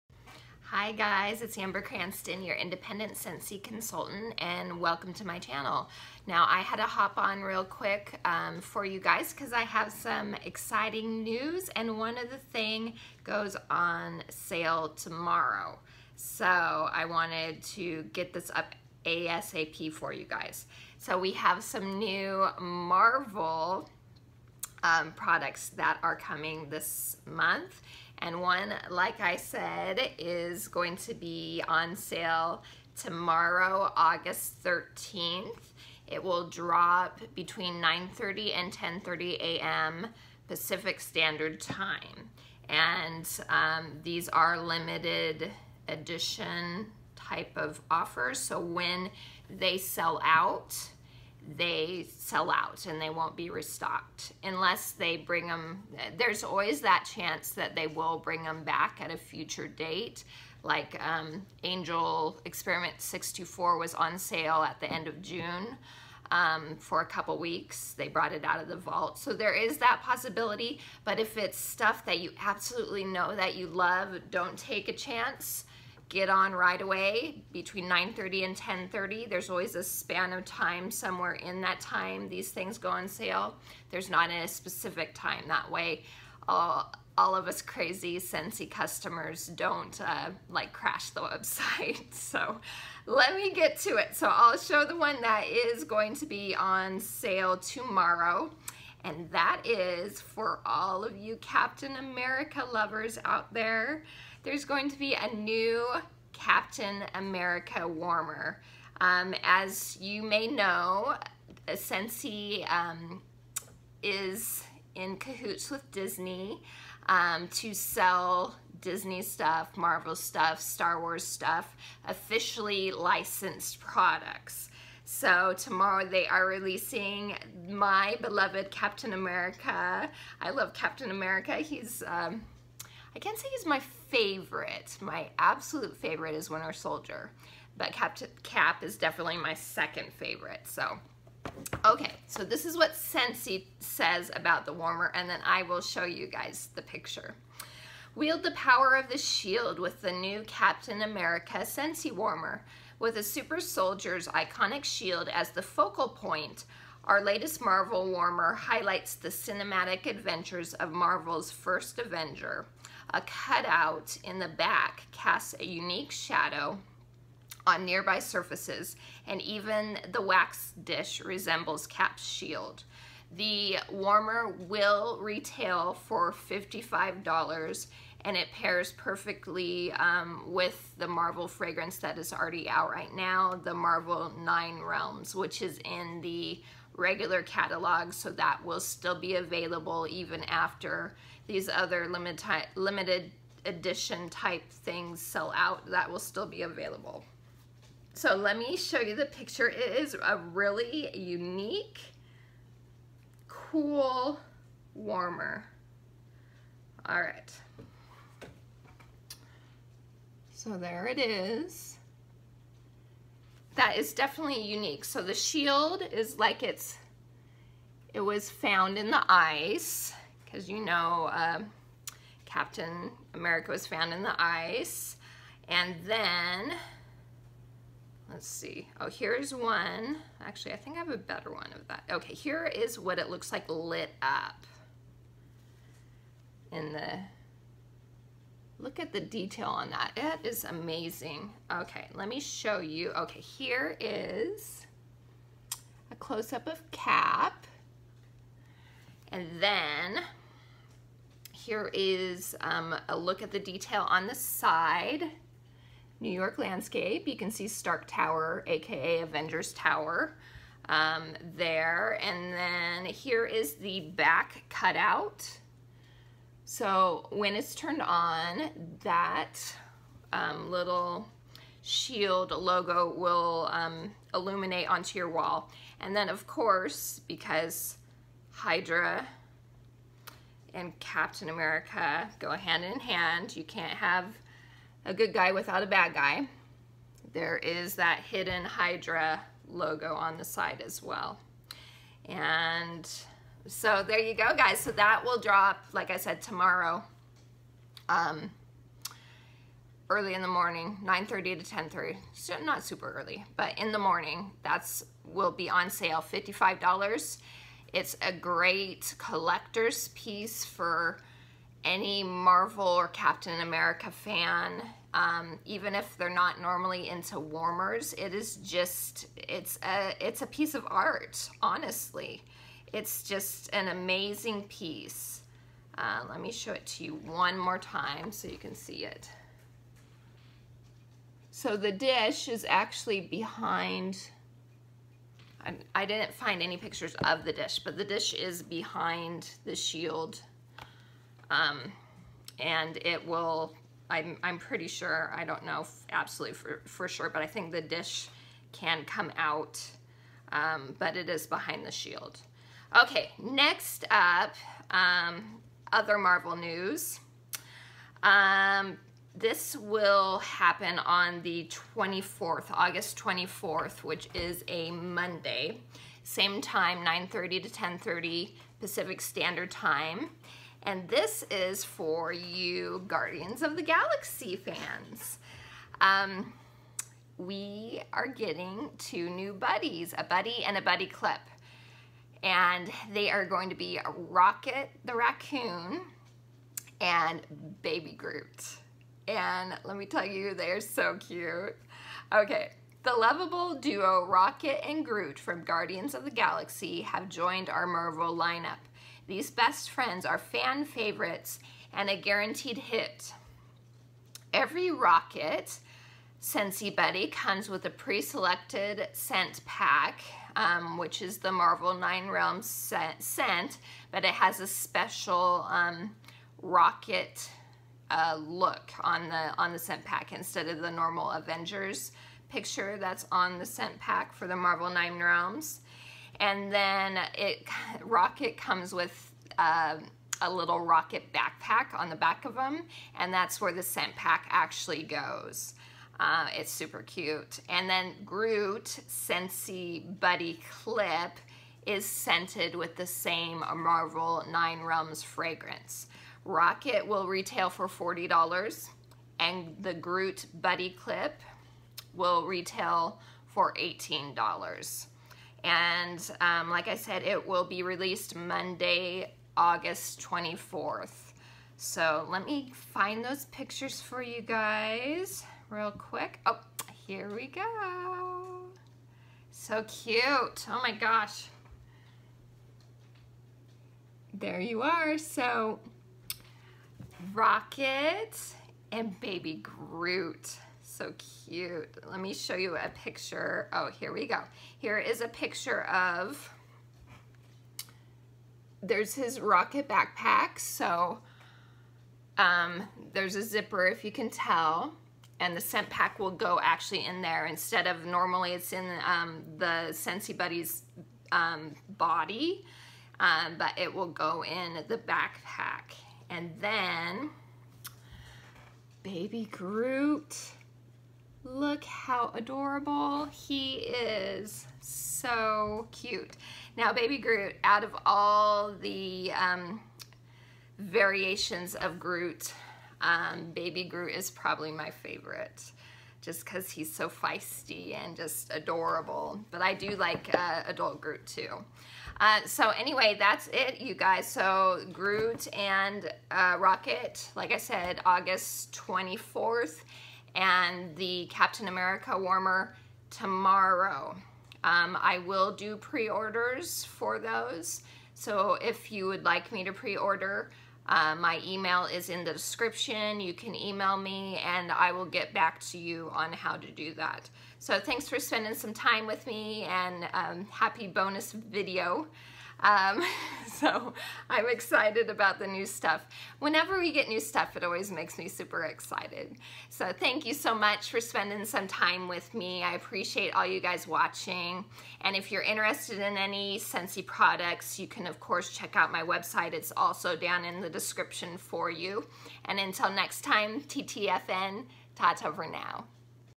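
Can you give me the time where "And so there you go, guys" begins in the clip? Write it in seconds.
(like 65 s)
292 s.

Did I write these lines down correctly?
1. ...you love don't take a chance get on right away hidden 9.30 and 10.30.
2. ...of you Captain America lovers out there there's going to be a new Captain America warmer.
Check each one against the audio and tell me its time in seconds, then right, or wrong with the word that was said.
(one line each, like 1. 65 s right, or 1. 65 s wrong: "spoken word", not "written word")
1. 73 s wrong: "between", not "hidden"
2. 101 s right.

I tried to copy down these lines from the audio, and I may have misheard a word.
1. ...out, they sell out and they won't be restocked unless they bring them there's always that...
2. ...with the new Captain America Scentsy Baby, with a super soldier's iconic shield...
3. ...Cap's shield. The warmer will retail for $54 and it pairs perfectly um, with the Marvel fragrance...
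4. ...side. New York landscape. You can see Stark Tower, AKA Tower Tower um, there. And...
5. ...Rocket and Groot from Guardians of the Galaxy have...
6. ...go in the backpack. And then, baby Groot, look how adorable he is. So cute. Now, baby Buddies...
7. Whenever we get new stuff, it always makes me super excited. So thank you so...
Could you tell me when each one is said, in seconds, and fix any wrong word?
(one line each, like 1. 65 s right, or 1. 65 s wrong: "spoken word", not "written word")
1. 50 s right
2. 149 s wrong: "Warmer", not "Baby"
3. 171 s wrong: "55", not "54"
4. 254 s wrong: "Avengers", not "Tower"
5. 394 s right
6. 504 s wrong: "Groot", not "Buddies"
7. 566 s right.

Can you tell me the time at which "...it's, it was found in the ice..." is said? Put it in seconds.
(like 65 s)
216 s.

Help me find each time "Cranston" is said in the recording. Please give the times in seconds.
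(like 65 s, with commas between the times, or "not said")
1 s.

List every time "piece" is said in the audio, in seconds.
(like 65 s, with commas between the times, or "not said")
310 s, 320 s, 324 s.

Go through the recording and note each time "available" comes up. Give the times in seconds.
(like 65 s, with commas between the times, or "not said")
189 s, 196 s.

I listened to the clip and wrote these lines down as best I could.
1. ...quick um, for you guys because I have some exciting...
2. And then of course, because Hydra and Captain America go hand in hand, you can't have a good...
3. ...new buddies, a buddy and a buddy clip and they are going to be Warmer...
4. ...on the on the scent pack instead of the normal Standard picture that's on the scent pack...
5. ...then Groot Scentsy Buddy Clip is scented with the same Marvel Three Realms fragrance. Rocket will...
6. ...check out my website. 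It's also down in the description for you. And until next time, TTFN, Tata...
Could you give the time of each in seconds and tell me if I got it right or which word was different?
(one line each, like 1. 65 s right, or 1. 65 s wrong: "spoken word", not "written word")
1. 7 s right
2. 275 s right
3. 379 s wrong: "Rocket", not "Warmer"
4. 419 s wrong: "Avengers", not "Standard"
5. 437 s wrong: "Nine", not "Three"
6. 578 s right.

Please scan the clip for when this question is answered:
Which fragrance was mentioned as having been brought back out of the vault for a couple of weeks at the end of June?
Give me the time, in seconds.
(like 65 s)
61 s.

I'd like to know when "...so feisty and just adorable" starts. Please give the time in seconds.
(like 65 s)
526 s.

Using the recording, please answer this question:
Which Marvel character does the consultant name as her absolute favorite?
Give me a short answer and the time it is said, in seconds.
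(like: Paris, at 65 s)
Winter Soldier, at 136 s.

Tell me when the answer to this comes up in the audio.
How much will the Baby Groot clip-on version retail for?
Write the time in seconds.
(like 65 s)
453 s.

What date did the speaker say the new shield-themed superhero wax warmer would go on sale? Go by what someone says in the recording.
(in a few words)
August 13th.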